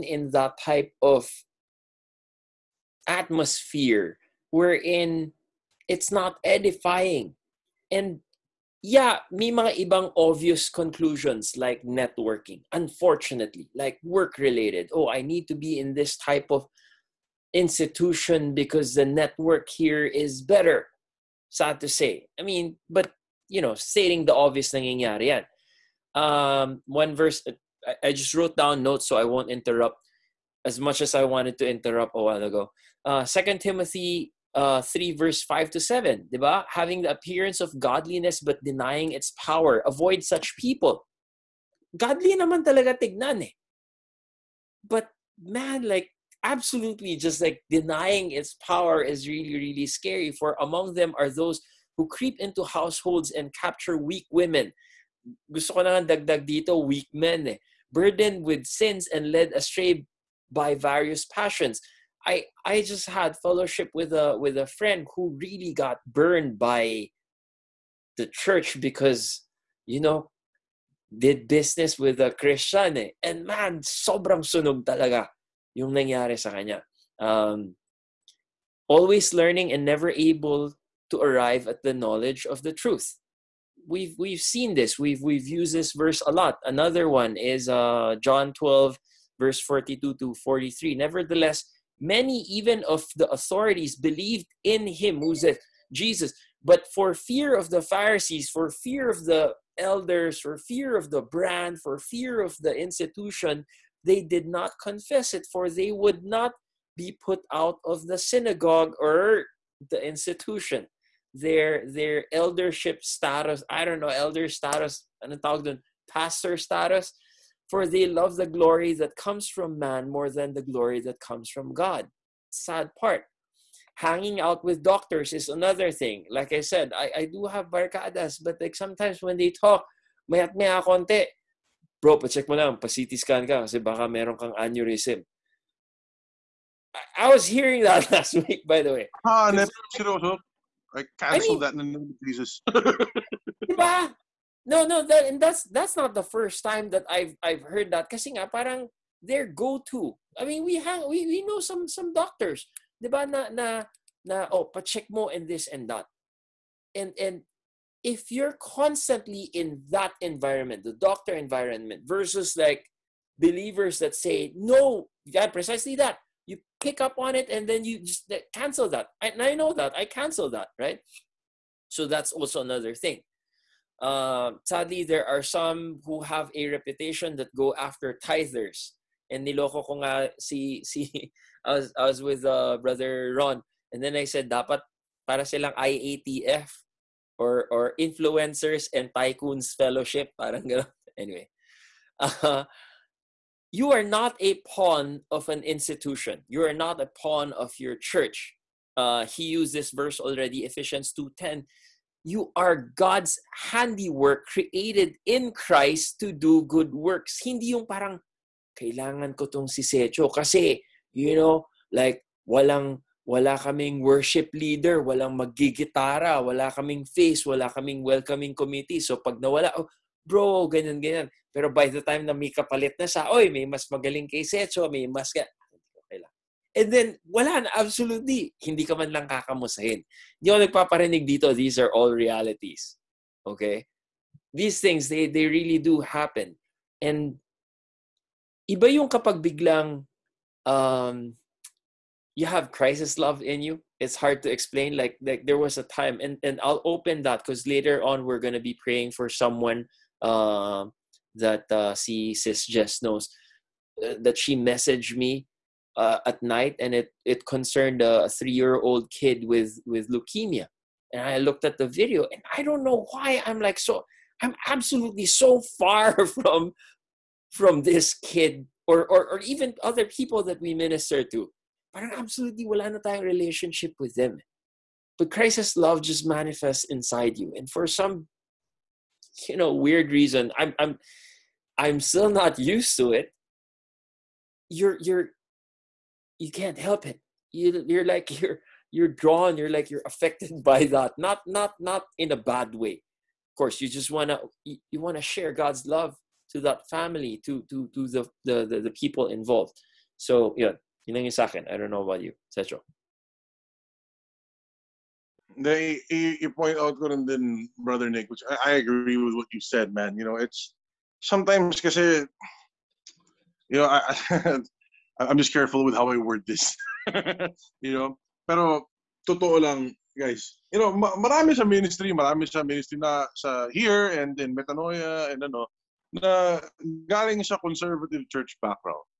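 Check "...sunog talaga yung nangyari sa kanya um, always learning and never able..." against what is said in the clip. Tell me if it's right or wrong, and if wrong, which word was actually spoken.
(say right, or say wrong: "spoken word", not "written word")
right.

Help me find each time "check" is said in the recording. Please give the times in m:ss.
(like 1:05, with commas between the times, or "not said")
2:12, 2:34.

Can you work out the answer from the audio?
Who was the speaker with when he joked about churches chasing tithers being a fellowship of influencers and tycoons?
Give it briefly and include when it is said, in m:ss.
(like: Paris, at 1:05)
Brother Ron, at 3:02.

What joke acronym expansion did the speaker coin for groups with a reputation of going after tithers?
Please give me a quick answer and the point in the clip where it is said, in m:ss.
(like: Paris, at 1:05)
Influencers and Tycoons Fellowship, at 3:07.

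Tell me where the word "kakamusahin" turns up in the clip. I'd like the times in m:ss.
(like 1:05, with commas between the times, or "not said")
3:49.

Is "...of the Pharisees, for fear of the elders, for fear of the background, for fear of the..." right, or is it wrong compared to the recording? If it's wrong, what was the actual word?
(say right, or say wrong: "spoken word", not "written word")
wrong: "brand", not "background".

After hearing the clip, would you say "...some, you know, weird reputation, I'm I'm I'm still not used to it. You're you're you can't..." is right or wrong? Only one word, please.
wrong.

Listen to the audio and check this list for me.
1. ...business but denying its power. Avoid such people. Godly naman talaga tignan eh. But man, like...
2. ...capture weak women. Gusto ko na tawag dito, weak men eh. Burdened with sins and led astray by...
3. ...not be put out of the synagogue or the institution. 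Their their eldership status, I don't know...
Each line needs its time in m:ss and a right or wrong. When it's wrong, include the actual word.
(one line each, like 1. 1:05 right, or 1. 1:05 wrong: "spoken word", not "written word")
1. 0:37 wrong: "godliness", not "business"
2. 0:53 wrong: "dagdag", not "tawag"
3. 1:46 right.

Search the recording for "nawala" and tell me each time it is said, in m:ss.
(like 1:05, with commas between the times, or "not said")
3:39.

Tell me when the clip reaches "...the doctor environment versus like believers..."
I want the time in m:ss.
2:40.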